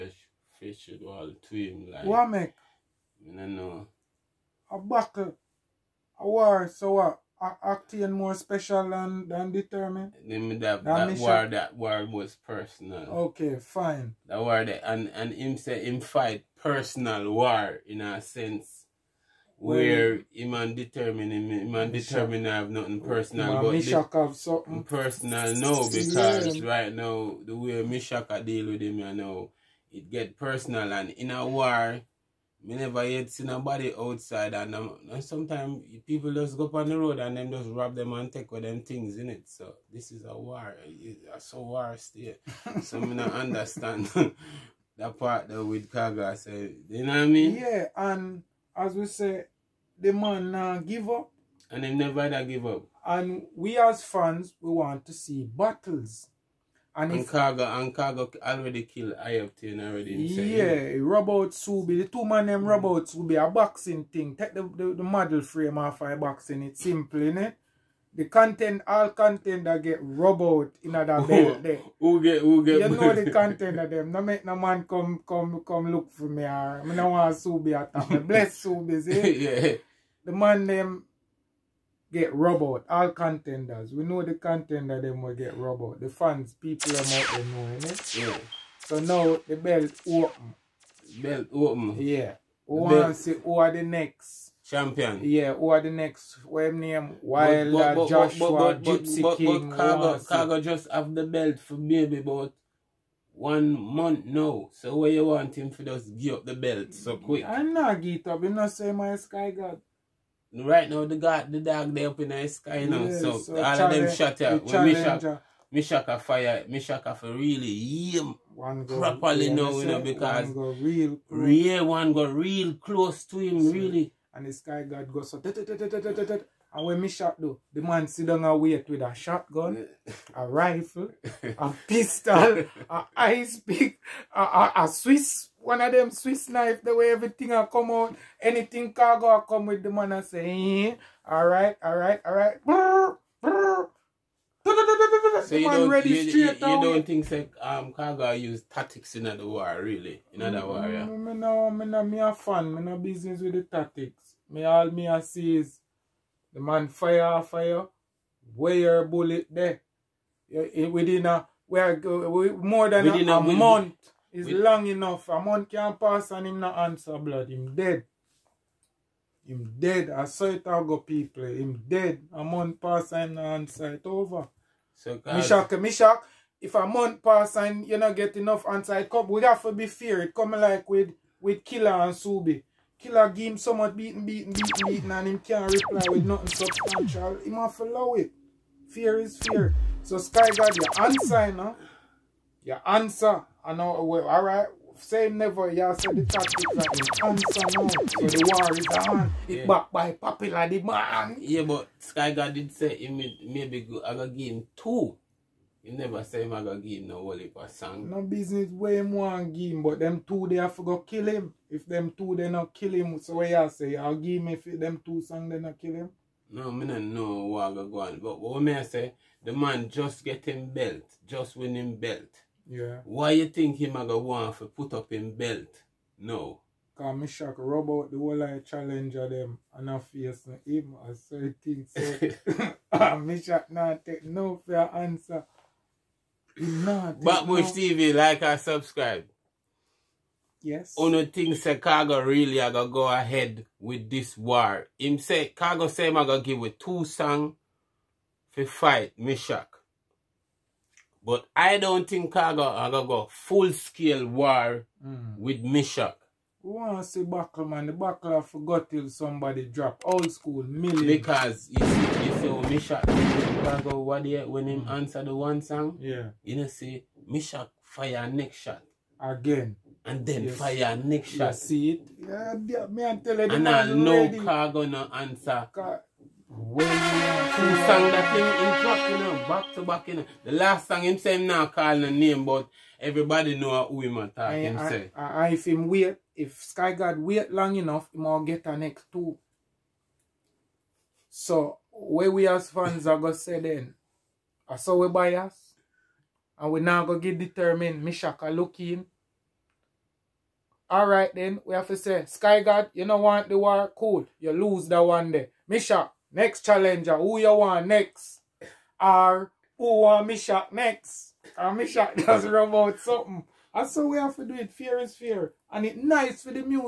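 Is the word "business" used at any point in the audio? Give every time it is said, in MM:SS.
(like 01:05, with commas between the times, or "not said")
02:32, 03:28.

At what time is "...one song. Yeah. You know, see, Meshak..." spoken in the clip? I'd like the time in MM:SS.
04:25.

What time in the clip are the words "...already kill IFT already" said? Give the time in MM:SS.
00:58.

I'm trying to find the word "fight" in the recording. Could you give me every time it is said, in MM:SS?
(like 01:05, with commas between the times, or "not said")
00:16, 04:08.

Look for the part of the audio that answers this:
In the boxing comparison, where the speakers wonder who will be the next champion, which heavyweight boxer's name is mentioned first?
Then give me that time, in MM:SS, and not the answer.
01:37.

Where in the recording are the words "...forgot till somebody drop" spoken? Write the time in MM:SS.
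04:18.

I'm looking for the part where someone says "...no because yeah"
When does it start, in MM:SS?
00:25.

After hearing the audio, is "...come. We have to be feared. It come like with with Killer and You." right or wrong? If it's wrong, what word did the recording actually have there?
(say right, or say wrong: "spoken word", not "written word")
wrong: "Subi", not "You".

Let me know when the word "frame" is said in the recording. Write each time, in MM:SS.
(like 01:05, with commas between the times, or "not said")
01:05.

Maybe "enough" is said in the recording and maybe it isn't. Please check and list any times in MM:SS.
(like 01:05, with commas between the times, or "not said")
02:44, 02:58, 04:47.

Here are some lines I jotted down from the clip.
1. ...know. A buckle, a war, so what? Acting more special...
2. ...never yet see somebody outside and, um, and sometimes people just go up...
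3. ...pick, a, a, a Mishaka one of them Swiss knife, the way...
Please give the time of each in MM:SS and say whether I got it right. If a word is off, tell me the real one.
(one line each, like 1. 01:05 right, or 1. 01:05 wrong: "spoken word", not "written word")
1. 00:03 right
2. 00:32 wrong: "nobody", not "somebody"
3. 02:13 wrong: "Swiss", not "Mishaka".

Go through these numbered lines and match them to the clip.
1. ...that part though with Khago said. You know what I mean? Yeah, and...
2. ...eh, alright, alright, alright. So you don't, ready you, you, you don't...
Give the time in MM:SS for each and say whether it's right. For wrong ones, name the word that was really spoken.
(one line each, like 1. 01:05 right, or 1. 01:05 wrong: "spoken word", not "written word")
1. 00:44 right
2. 02:20 right.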